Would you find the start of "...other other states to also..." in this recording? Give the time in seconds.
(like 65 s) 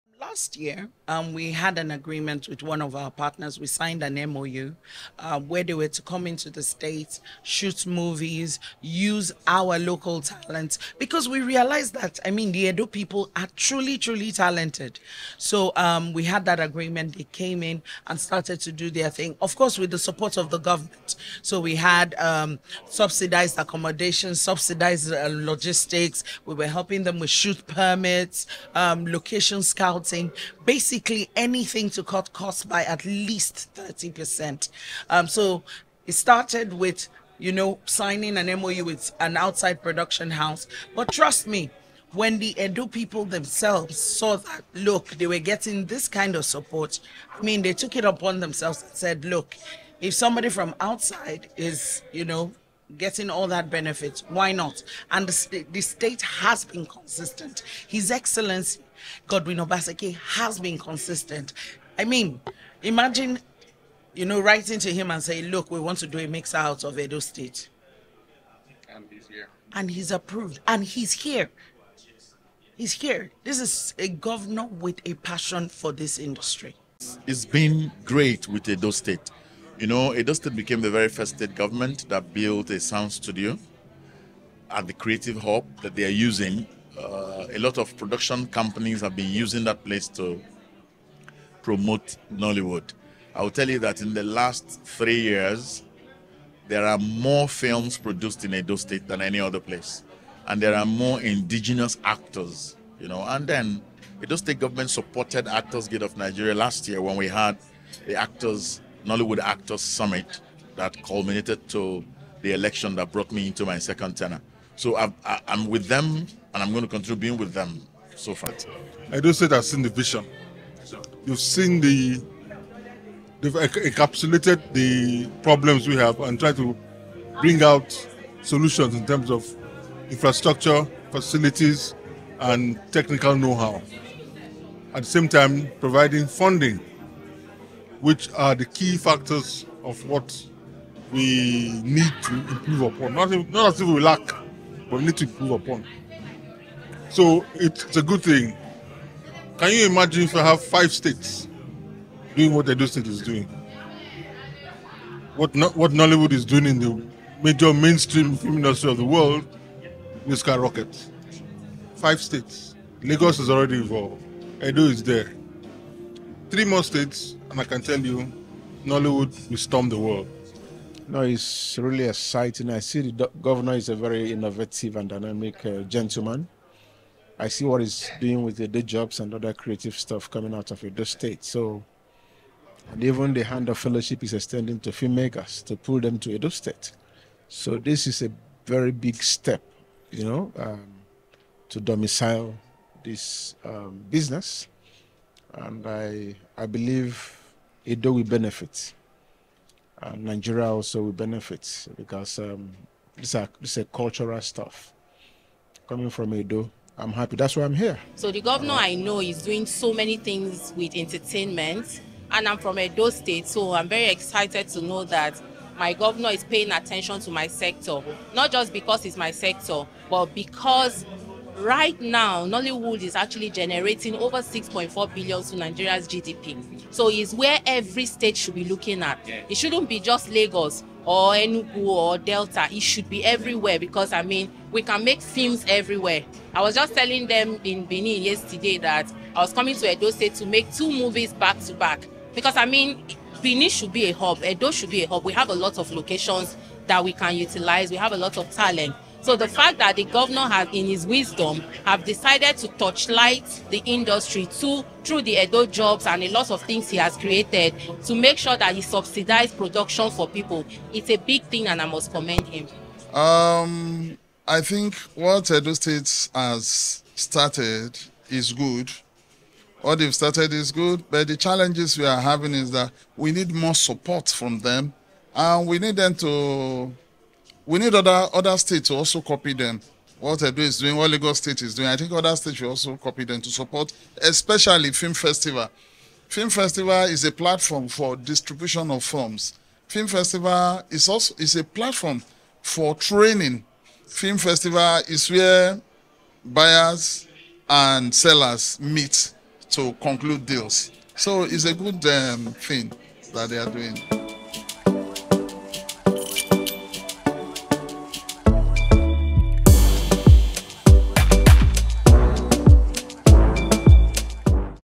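277 s.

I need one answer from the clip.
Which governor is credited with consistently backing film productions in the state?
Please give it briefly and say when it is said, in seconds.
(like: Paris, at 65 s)
Godwin Obaseki, at 59 s.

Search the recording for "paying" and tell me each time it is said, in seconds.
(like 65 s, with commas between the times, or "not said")
216 s.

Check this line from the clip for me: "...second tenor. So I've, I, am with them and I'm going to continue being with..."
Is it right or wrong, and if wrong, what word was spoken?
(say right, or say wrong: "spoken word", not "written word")
right.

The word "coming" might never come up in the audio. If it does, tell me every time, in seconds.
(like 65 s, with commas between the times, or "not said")
180 s, 205 s, 239 s.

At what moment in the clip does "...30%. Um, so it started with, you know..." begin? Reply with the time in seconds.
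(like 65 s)
33 s.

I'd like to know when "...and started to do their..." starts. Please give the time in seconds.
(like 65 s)
18 s.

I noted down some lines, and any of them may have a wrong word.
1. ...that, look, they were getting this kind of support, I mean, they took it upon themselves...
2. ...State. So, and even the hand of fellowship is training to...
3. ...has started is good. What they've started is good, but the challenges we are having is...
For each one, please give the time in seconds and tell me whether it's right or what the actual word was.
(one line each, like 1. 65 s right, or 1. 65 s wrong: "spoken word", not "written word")
1. 44 s right
2. 181 s wrong: "extending", not "training"
3. 266 s right.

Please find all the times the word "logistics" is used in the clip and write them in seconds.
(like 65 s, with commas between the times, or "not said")
25 s.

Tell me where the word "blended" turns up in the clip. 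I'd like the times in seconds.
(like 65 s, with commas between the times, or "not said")
not said.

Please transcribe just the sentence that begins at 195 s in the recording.
And I, I believe Edo will benefit.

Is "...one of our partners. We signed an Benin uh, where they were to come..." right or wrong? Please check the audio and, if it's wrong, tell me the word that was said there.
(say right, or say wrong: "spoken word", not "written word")
wrong: "MOU", not "Benin".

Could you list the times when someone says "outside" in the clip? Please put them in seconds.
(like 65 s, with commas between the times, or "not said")
39 s, 50 s.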